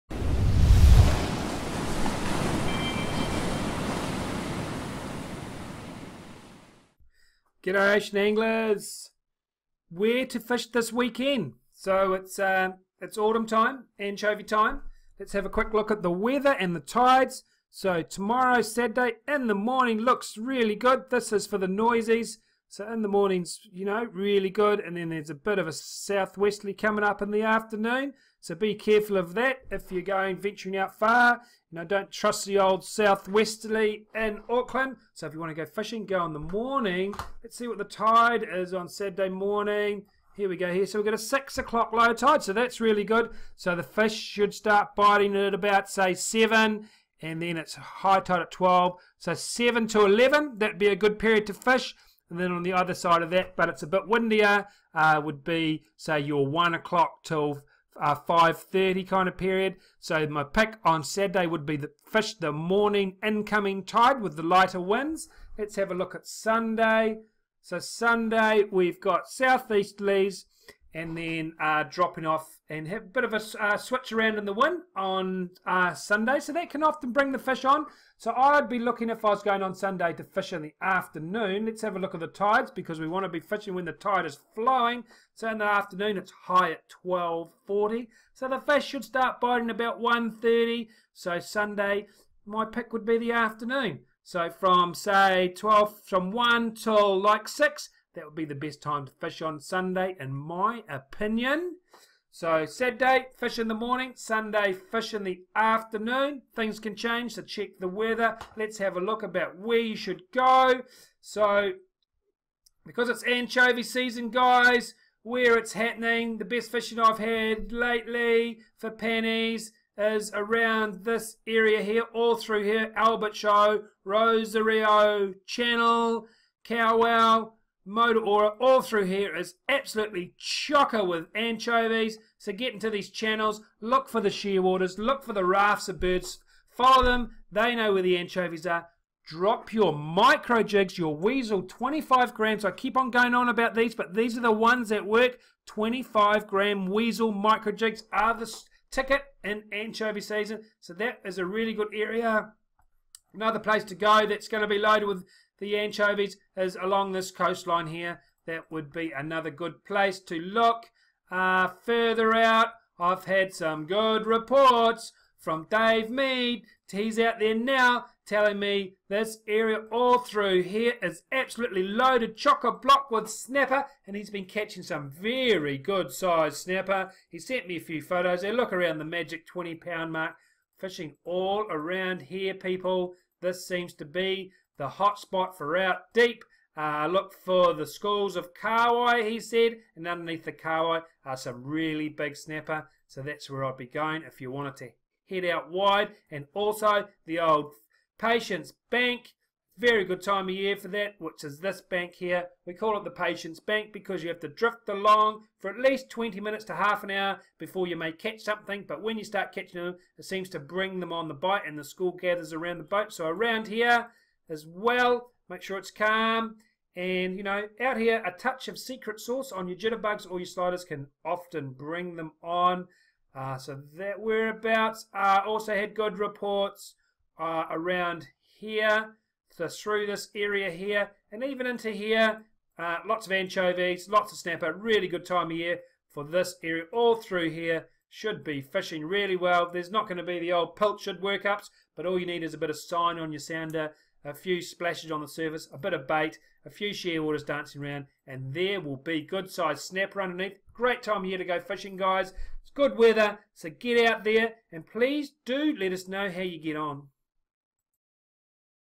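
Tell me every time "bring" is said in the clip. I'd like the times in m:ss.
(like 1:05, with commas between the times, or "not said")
1:17, 3:30, 3:41.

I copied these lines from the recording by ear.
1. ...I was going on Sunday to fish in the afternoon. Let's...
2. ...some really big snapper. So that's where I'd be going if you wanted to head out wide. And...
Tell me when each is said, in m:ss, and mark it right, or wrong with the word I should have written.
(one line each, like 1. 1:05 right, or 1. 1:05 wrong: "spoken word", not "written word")
1. 1:19 right
2. 3:11 right.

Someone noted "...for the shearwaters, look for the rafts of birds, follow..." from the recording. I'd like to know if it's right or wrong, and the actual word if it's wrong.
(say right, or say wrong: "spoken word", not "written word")
right.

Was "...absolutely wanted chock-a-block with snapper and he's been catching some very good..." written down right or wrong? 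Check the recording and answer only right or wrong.
wrong.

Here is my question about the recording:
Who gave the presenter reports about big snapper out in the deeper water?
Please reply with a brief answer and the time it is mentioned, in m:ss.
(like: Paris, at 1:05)
Dave Mead, at 2:45.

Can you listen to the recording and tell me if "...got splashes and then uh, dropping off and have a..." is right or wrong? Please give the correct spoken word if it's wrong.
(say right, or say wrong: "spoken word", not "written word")
wrong: "southeasterlies", not "splashes".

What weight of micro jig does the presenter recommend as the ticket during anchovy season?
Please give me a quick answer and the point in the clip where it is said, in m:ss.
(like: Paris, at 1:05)
25 grams, at 2:25.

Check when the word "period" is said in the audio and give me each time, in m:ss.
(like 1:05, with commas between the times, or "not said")
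0:51, 0:59.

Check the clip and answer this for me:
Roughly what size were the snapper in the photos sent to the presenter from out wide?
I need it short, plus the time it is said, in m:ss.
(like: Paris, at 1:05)
20 pounds, at 2:59.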